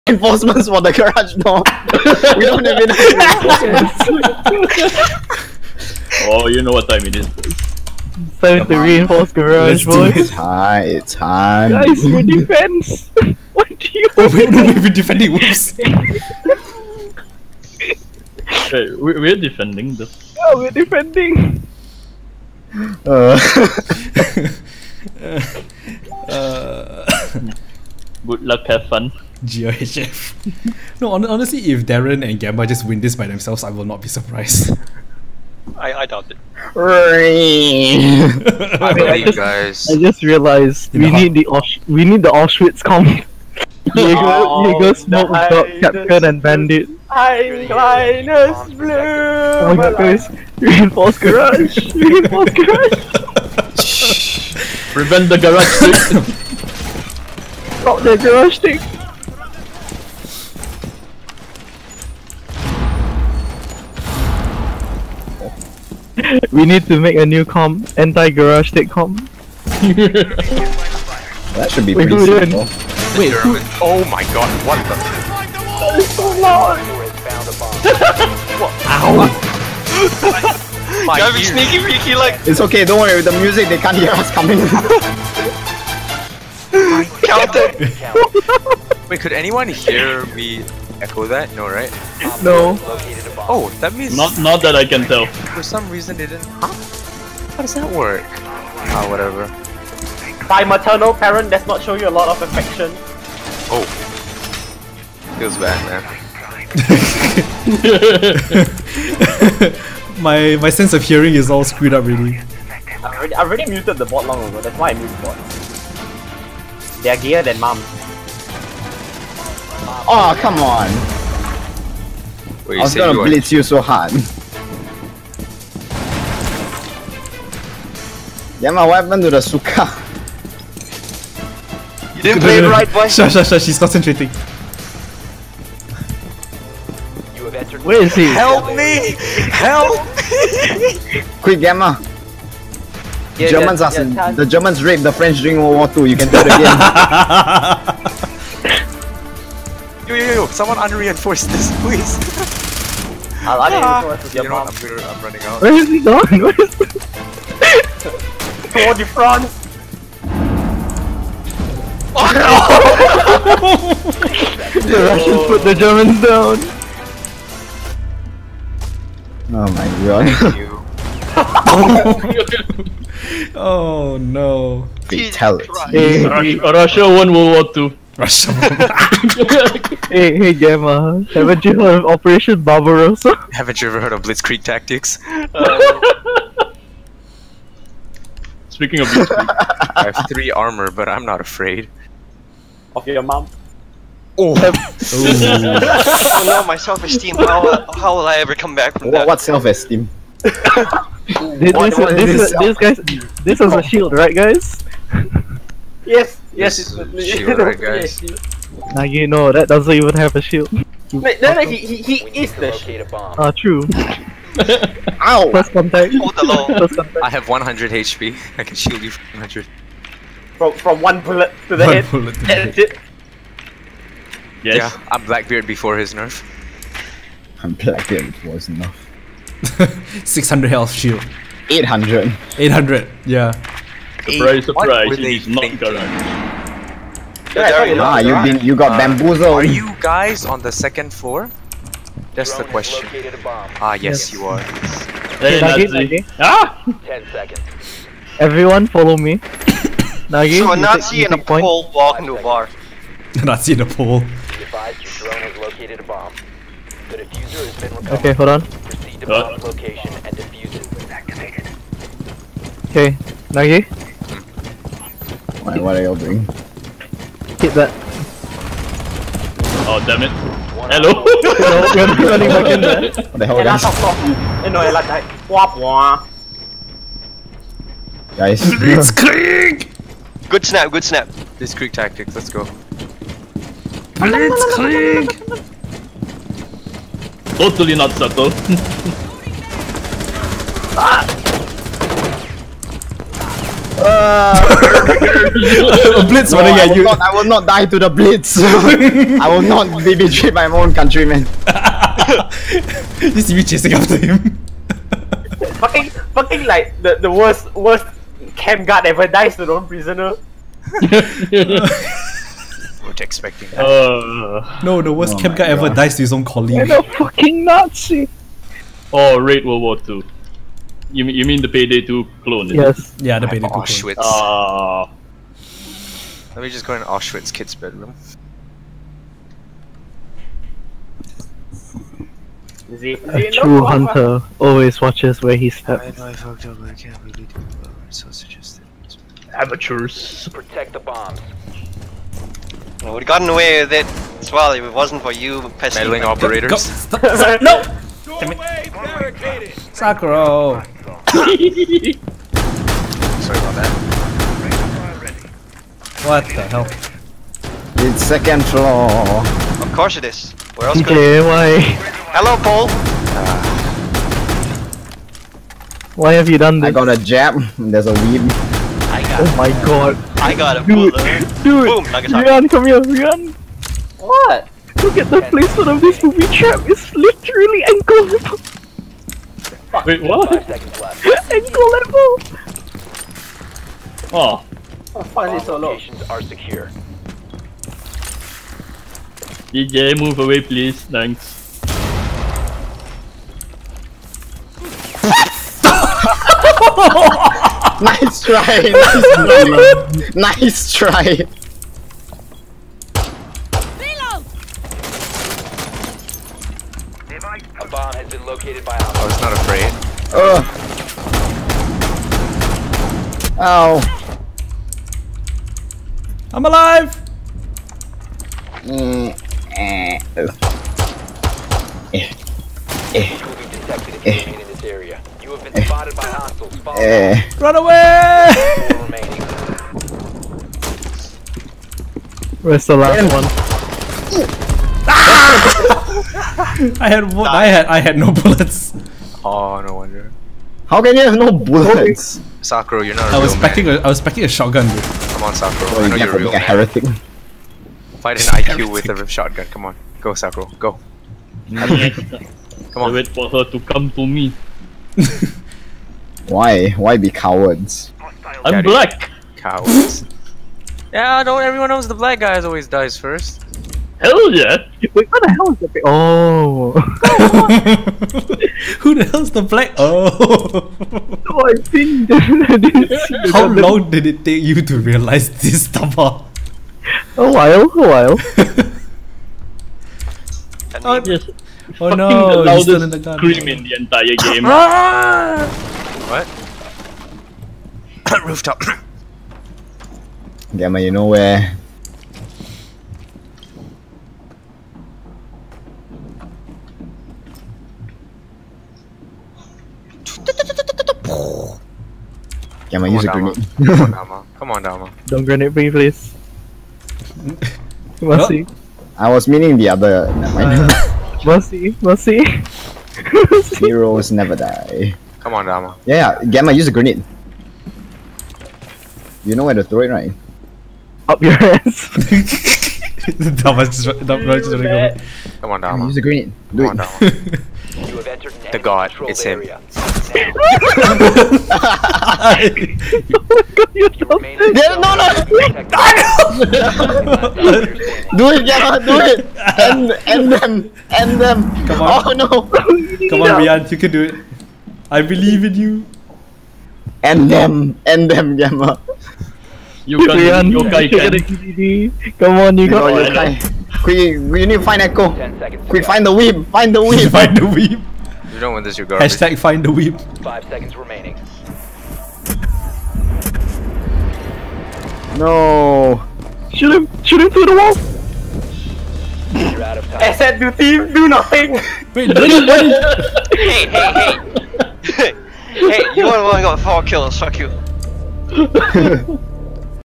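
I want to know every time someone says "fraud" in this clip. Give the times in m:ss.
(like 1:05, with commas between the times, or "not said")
not said.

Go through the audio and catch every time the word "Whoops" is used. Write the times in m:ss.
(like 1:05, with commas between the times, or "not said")
0:15.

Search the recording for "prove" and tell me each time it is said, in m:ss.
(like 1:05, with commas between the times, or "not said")
not said.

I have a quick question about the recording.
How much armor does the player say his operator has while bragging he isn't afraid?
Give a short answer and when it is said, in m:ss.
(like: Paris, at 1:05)
3, at 3:10.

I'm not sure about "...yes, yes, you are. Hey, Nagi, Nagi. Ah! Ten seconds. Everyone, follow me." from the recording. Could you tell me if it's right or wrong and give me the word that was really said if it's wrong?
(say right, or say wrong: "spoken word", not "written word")
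right.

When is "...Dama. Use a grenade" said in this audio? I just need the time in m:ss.
8:45.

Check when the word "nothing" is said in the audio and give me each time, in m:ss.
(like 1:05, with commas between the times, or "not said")
9:31.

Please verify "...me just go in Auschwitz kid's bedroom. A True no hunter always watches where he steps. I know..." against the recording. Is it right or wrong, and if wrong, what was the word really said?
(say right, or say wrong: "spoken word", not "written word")
right.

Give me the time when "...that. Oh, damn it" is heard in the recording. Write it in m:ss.
4:27.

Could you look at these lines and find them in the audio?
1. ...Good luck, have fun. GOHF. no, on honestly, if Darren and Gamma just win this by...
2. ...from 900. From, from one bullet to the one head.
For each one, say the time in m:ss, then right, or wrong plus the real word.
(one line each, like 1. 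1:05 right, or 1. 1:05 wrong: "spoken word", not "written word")
1. 0:28 right
2. 3:39 wrong: "100", not "900".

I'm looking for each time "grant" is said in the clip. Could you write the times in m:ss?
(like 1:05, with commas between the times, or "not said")
not said.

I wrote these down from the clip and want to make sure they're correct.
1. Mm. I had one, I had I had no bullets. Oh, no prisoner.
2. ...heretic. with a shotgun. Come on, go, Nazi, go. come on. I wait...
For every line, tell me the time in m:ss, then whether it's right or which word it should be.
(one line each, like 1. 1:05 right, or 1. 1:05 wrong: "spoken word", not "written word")
1. 7:14 wrong: "wonder", not "prisoner"
2. 7:28 wrong: "Sakura", not "Nazi".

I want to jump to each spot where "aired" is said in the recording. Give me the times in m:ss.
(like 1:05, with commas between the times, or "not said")
not said.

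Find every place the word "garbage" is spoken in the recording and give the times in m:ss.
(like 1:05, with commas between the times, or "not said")
9:19.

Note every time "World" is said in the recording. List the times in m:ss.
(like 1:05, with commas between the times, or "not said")
2:25, 2:57, 5:19.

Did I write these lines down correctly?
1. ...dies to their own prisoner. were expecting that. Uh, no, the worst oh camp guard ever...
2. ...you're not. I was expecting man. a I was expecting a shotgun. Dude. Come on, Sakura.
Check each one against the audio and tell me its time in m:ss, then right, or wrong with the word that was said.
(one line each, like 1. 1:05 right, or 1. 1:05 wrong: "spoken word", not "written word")
1. 5:09 right
2. 7:23 right.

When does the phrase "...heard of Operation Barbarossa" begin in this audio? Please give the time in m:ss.
3:01.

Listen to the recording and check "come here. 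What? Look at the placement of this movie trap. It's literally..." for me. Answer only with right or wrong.
right.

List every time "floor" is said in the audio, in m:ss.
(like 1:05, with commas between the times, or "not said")
4:01, 5:58.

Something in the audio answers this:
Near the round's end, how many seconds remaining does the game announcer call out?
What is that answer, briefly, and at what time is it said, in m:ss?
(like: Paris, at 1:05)
5, at 9:20.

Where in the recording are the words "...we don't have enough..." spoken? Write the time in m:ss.
0:02.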